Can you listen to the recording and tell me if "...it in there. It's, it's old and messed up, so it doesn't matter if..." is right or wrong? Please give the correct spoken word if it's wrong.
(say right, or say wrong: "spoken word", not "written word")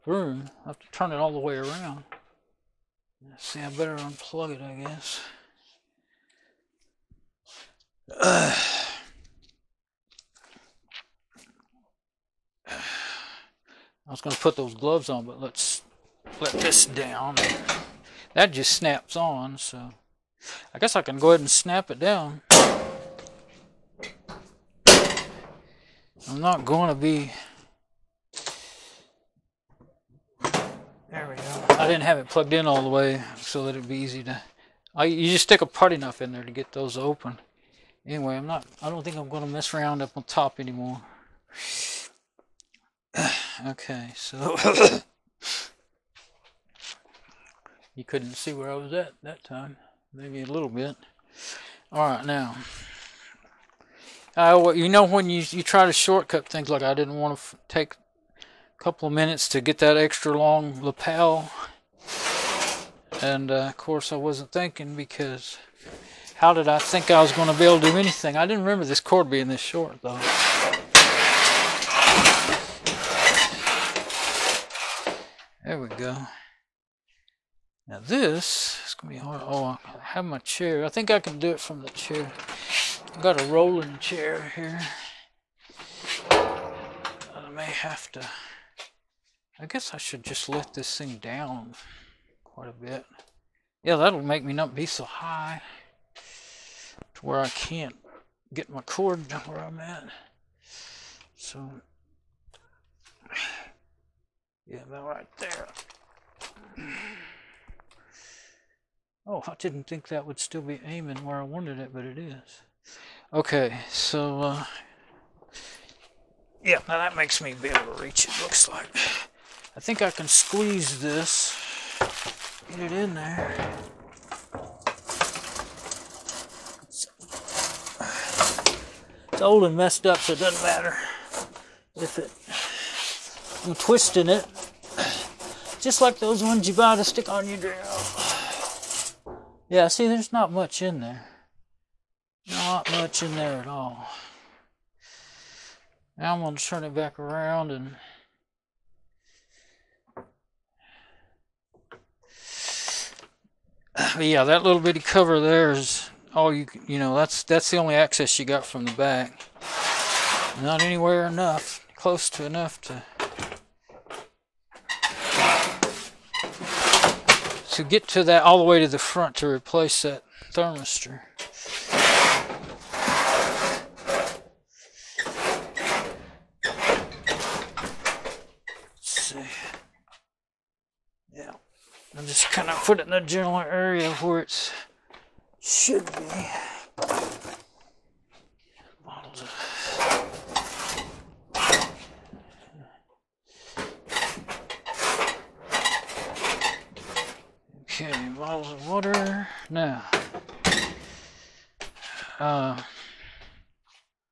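right.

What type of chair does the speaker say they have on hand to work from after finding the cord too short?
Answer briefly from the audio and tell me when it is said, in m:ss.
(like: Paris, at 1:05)
rolling chair, at 1:23.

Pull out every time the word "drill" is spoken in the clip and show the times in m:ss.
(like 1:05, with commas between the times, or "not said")
2:17.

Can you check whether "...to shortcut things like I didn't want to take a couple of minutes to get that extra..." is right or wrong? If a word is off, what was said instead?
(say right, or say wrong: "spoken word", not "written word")
right.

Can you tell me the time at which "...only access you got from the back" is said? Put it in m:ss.
2:37.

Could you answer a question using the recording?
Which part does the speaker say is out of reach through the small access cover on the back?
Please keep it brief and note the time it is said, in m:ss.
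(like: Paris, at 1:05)
thermistor, at 2:50.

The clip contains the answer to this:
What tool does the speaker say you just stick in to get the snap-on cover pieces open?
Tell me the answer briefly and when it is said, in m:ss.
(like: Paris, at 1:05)
putty knife, at 0:35.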